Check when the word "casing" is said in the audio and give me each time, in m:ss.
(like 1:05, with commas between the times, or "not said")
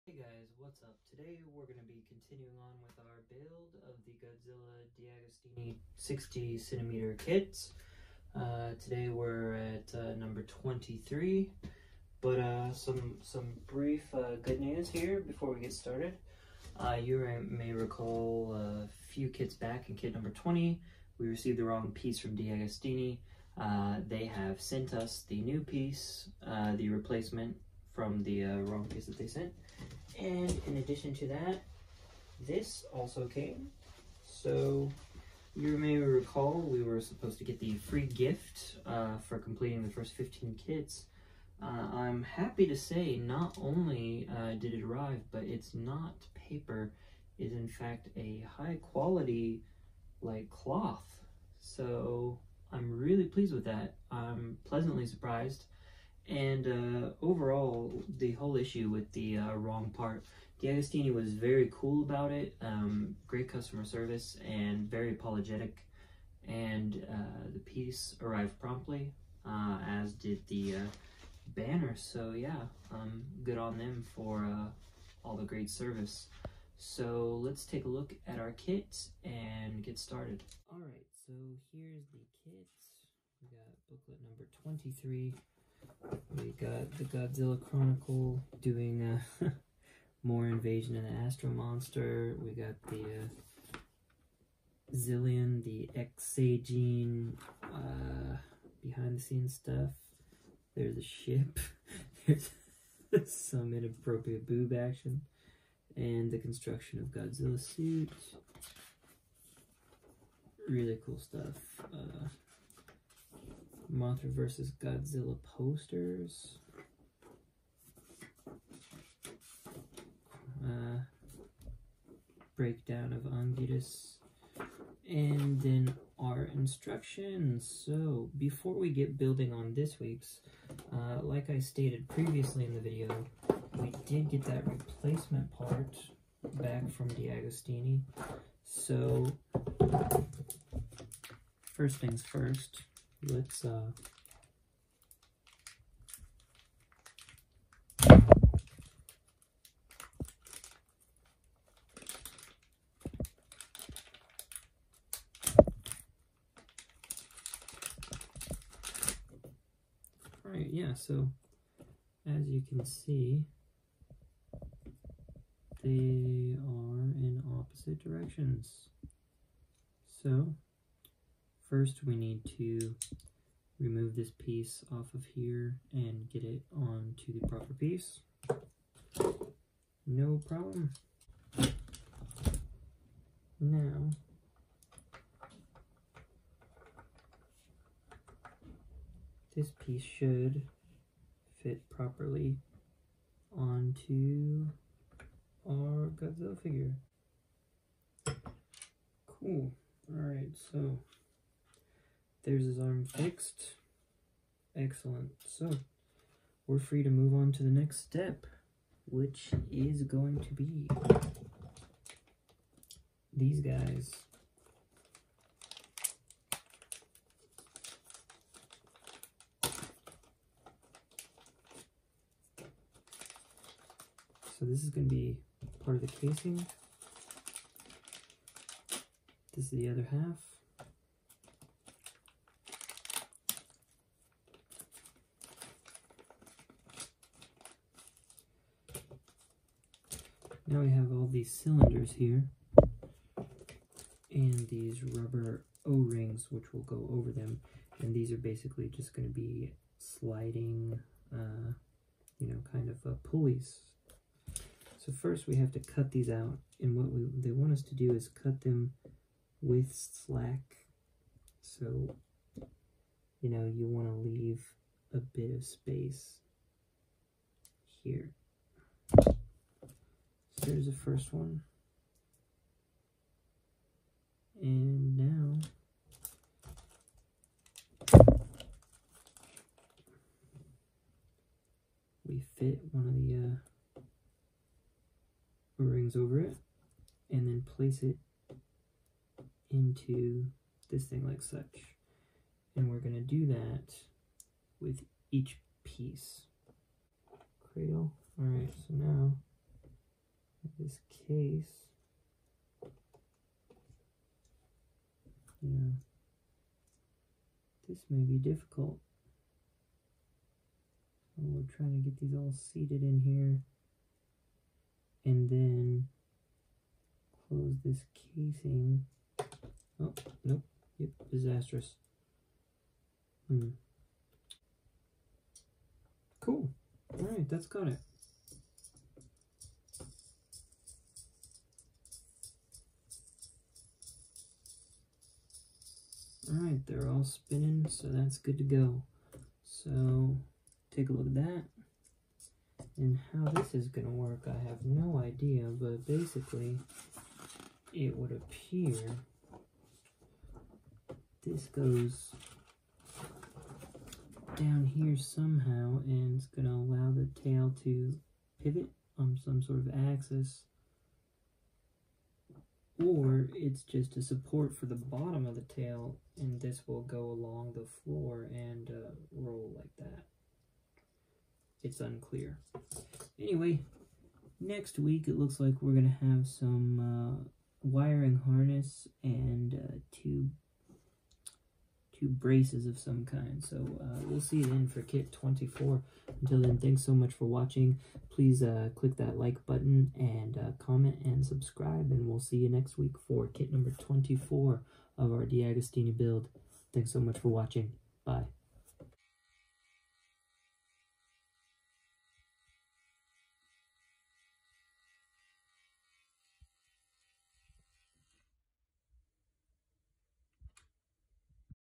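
3:46, 5:18.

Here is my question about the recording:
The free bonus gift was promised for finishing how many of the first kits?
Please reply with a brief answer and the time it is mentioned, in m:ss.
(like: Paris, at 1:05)
15, at 0:39.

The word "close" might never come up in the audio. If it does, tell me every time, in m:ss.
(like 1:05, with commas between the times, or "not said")
5:17.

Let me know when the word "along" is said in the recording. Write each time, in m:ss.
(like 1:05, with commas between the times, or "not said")
6:07.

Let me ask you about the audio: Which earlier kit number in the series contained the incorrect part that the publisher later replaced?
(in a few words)
20.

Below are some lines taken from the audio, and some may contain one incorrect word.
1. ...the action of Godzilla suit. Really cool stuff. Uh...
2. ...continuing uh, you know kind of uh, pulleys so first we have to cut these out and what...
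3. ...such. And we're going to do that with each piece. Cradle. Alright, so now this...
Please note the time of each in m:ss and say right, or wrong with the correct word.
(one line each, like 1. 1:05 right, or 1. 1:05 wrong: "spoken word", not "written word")
1. 1:46 wrong: "construction", not "action"
2. 4:09 wrong: "sliding", not "continuing"
3. 4:51 right.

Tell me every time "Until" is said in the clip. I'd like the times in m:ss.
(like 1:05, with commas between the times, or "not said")
6:26.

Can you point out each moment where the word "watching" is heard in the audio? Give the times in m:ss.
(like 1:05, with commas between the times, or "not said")
6:27, 6:37.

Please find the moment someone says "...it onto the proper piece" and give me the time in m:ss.
2:56.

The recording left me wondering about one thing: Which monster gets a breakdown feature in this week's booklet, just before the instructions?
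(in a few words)
Anguirus.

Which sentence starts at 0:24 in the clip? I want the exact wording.
they have sent us the new piece, the replacement from the uh, wrong piece that they sent.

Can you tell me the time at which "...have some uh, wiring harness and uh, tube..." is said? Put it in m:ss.
6:16.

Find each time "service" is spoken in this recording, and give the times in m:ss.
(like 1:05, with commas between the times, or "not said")
1:03, 1:15.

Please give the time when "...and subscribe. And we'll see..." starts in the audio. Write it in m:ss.
6:31.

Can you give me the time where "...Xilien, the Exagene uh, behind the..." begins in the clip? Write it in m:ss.
1:34.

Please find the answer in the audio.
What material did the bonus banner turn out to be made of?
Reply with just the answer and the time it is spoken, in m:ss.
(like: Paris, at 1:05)
Cloth, at 0:50.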